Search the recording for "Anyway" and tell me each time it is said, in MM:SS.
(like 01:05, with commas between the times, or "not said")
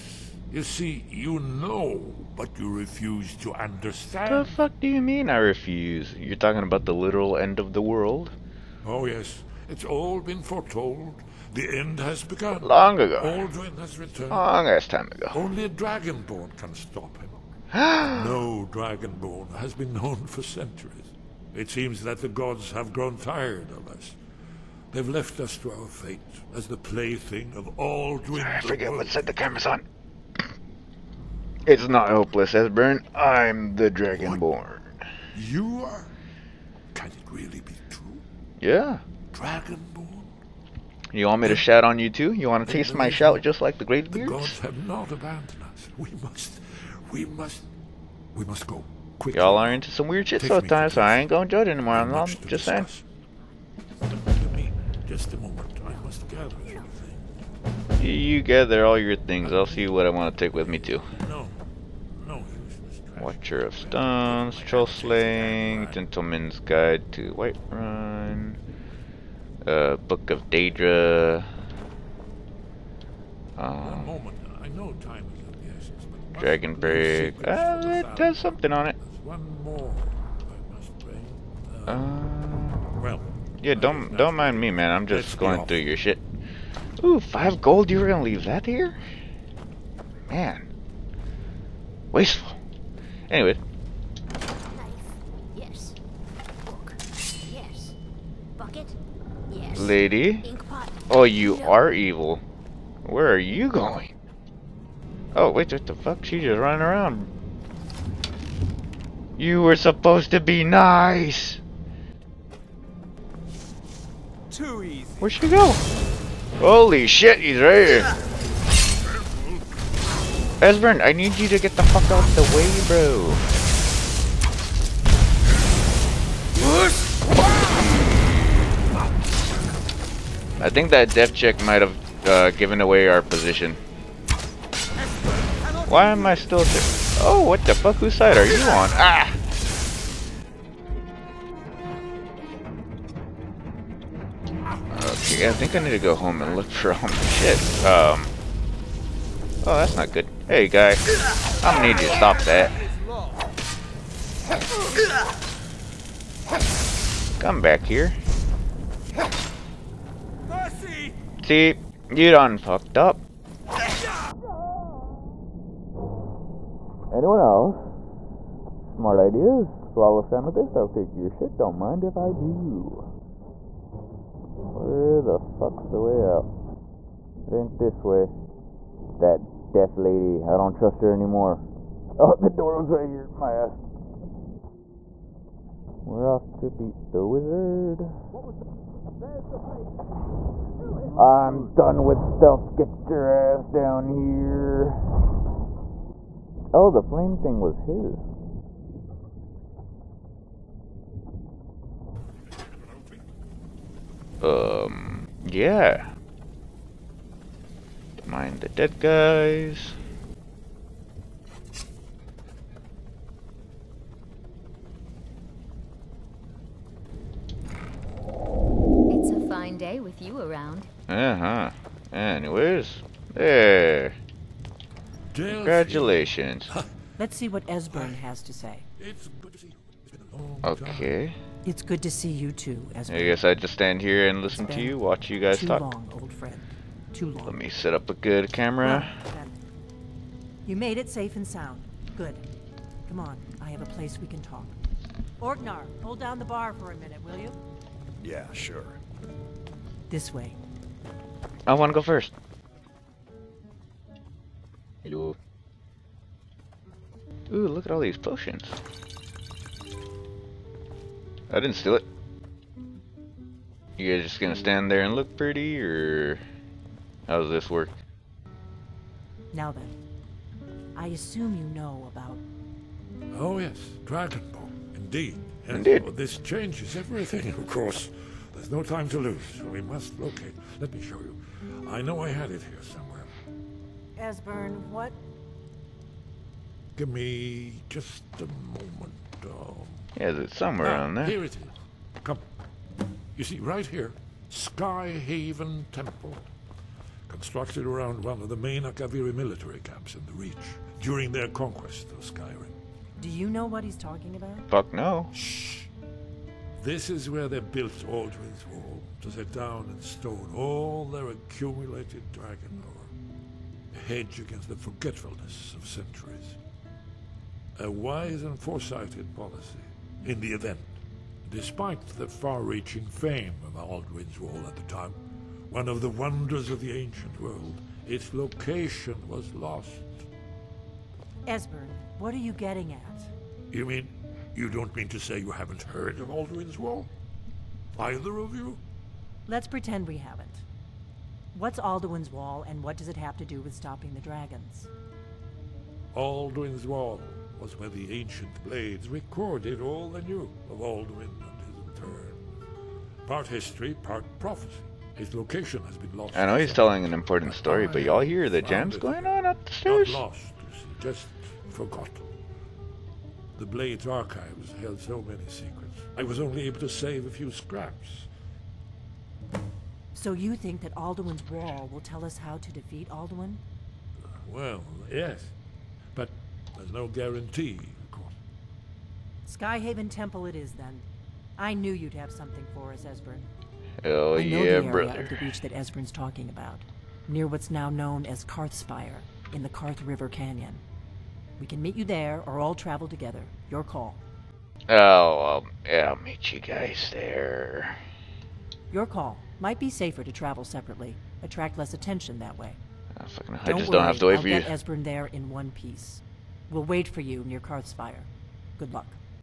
01:33, 03:42.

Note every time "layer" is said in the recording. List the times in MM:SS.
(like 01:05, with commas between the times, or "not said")
not said.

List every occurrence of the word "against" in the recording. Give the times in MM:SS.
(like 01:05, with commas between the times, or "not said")
05:14.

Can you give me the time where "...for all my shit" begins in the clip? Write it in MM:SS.
02:26.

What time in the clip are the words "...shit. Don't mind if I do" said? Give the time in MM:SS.
02:51.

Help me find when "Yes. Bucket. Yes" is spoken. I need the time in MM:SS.
01:37.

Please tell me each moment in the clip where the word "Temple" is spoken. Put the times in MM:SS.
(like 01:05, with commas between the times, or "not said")
04:55, 06:20.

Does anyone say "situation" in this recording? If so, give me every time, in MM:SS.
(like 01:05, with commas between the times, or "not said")
not said.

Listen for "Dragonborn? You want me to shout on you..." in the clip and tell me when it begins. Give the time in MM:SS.
00:39.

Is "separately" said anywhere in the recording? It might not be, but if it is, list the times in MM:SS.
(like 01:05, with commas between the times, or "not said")
06:40.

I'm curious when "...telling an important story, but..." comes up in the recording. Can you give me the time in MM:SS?
05:56.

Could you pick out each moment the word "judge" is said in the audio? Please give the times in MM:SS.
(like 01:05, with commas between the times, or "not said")
00:51.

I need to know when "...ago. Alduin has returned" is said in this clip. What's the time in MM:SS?
00:13.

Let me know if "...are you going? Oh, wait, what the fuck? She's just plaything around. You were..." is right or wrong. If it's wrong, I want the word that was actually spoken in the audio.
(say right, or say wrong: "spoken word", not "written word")
wrong: "running", not "plaything".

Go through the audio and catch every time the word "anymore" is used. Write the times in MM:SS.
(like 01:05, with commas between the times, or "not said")
00:51, 03:01.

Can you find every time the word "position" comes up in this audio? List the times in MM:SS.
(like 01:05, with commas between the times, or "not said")
02:13.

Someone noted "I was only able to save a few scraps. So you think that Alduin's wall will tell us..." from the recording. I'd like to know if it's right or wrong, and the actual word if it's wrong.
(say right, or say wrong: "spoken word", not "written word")
right.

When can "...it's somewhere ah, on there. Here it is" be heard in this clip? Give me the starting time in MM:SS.
04:50.